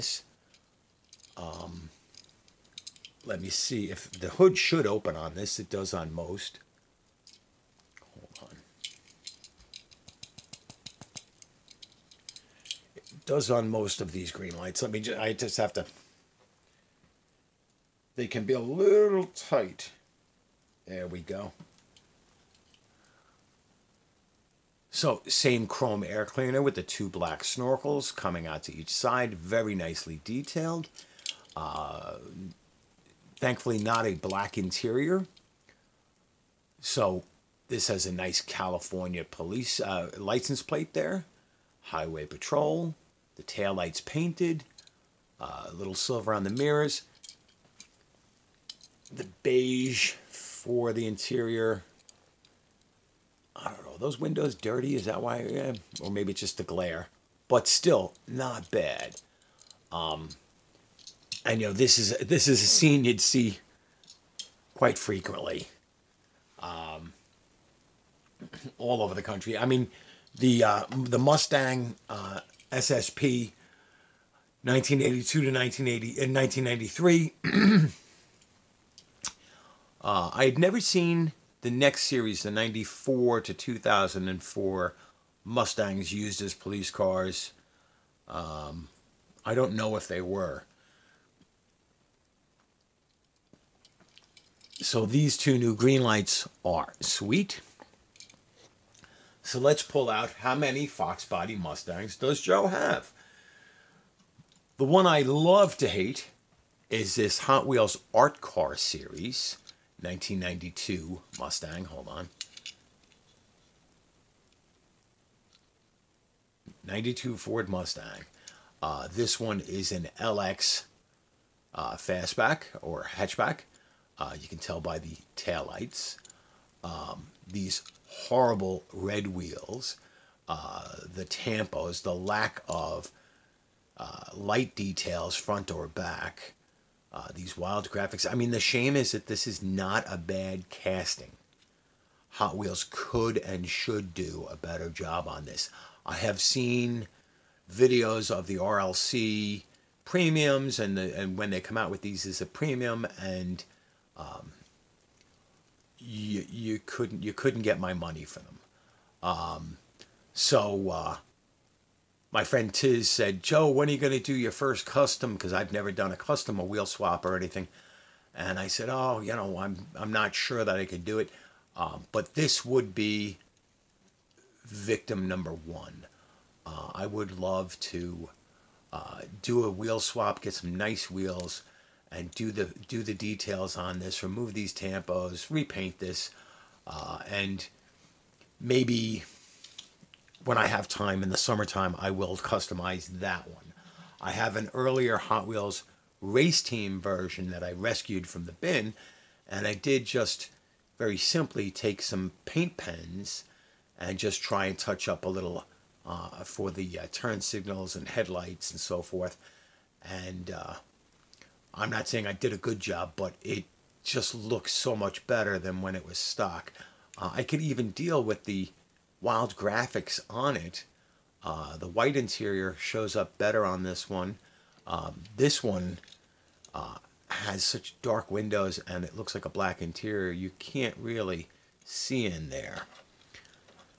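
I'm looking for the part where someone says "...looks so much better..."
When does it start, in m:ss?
3:34.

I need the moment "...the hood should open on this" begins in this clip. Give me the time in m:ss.
0:04.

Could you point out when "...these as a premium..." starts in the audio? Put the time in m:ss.
2:32.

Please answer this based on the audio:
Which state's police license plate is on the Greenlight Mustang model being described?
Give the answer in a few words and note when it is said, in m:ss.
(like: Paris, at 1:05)
California, at 0:38.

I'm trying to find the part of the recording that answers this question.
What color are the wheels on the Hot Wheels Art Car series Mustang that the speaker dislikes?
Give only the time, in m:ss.
2:08.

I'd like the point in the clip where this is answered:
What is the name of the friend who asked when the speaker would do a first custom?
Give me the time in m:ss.
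2:42.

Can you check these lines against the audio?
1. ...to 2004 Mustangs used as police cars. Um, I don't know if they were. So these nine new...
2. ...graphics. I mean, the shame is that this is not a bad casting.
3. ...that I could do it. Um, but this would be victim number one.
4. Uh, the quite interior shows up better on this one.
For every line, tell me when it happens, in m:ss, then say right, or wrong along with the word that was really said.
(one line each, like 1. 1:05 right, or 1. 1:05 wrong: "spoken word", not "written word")
1. 1:23 wrong: "two", not "nine"
2. 2:17 right
3. 2:50 right
4. 3:41 wrong: "white", not "quite".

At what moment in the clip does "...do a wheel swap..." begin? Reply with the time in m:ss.
2:59.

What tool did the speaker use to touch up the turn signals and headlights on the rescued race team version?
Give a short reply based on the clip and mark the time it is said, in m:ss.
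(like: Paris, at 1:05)
Paint pens, at 3:22.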